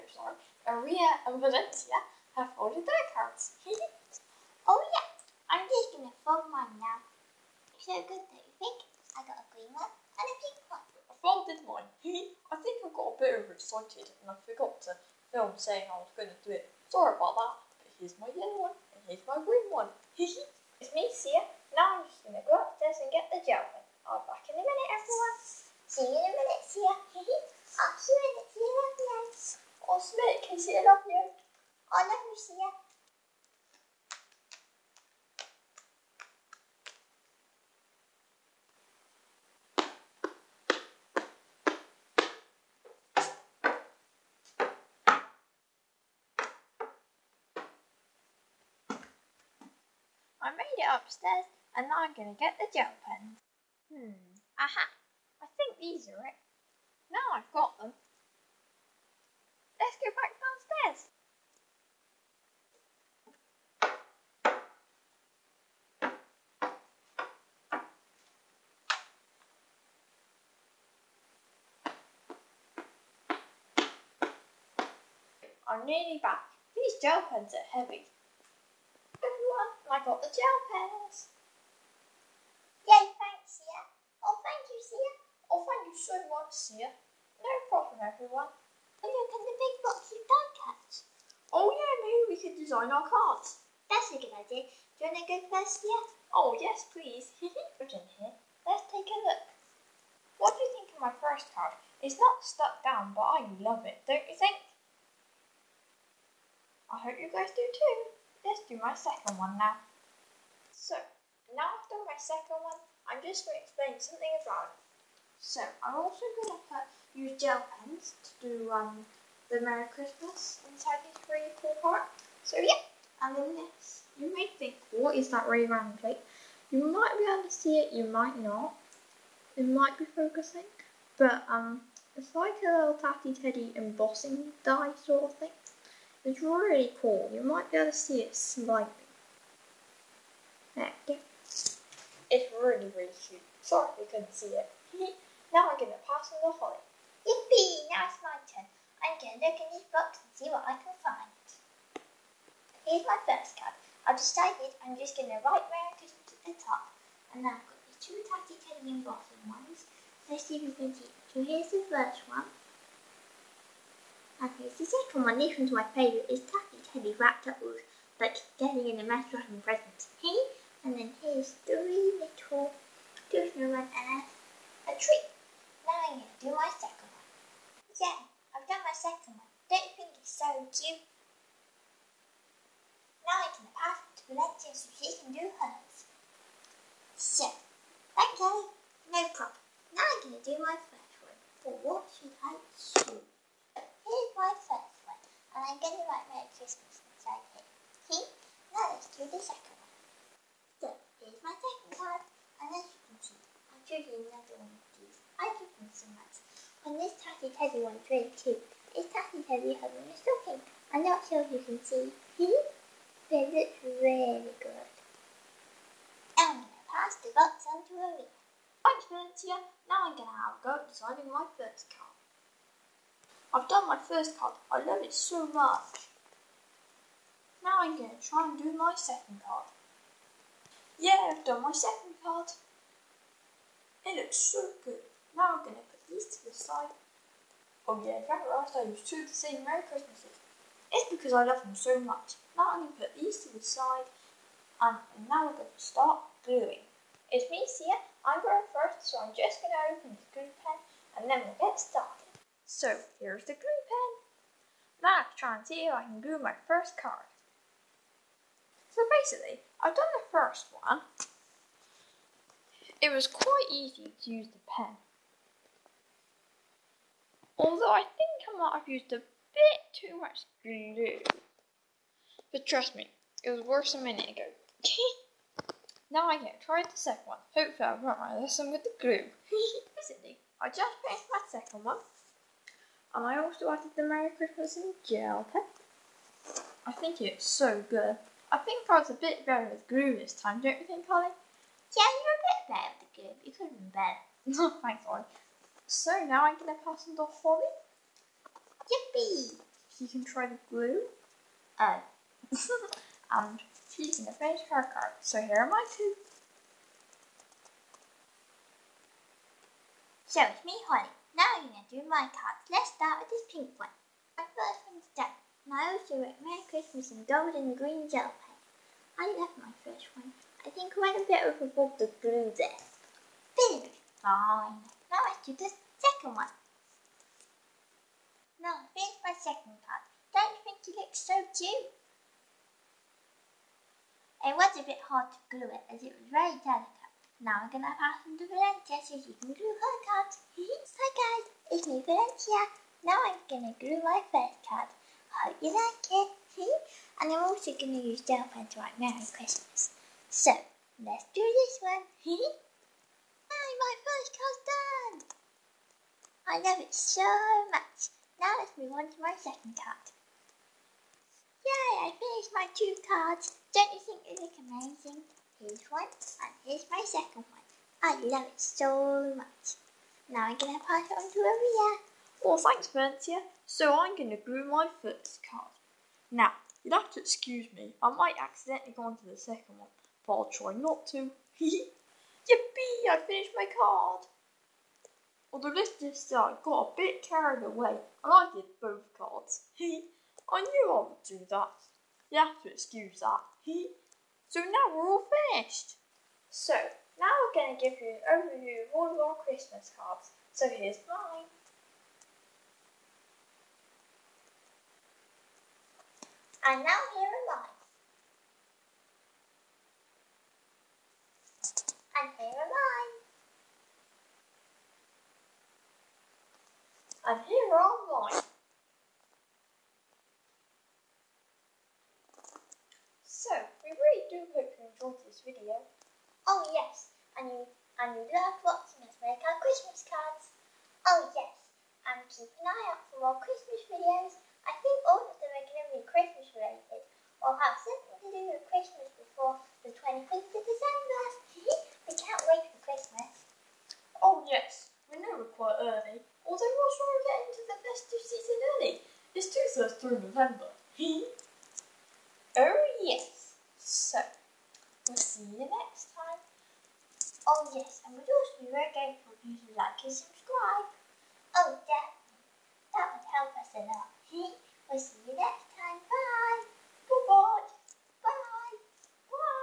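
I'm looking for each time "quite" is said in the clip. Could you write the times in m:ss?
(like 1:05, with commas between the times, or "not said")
4:23, 7:25.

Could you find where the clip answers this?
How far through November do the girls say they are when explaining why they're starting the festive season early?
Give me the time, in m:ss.
7:29.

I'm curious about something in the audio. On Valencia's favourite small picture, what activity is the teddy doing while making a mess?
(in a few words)
wrapping present.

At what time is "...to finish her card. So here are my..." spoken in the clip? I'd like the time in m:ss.
5:04.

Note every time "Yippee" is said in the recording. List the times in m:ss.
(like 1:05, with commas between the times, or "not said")
2:27, 4:58, 6:21.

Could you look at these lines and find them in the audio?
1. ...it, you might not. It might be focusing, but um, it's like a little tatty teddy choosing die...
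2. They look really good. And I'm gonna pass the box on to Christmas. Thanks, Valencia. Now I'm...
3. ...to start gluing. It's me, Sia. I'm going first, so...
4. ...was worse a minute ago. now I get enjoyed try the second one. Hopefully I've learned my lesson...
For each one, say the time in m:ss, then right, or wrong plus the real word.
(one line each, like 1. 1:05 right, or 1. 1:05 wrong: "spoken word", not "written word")
1. 2:07 wrong: "embossing", not "choosing"
2. 3:33 wrong: "Aria", not "Christmas"
3. 4:05 right
4. 4:33 wrong: "tried", not "enjoyed".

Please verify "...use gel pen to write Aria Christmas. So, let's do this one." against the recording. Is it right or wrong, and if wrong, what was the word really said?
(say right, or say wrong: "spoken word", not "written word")
wrong: "Merry", not "Aria".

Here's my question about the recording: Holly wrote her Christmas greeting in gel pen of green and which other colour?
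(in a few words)
gold.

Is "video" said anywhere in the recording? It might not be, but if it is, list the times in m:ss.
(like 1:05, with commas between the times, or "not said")
7:05, 7:13.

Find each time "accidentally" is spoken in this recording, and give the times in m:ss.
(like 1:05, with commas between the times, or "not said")
6:18.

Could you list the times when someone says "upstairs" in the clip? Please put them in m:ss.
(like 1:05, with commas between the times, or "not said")
0:22, 0:50.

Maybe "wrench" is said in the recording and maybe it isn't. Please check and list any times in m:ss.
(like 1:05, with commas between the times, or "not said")
not said.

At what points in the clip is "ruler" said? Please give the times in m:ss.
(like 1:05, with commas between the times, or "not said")
not said.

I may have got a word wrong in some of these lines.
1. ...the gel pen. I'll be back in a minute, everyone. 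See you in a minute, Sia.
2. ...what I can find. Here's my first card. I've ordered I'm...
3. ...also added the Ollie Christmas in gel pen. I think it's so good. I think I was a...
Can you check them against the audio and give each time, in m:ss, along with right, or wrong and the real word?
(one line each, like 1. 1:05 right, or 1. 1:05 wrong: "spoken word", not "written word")
1. 0:23 right
2. 2:30 wrong: "decided", not "ordered"
3. 4:43 wrong: "Merry", not "Ollie".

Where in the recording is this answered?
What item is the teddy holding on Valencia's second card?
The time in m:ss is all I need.
3:29.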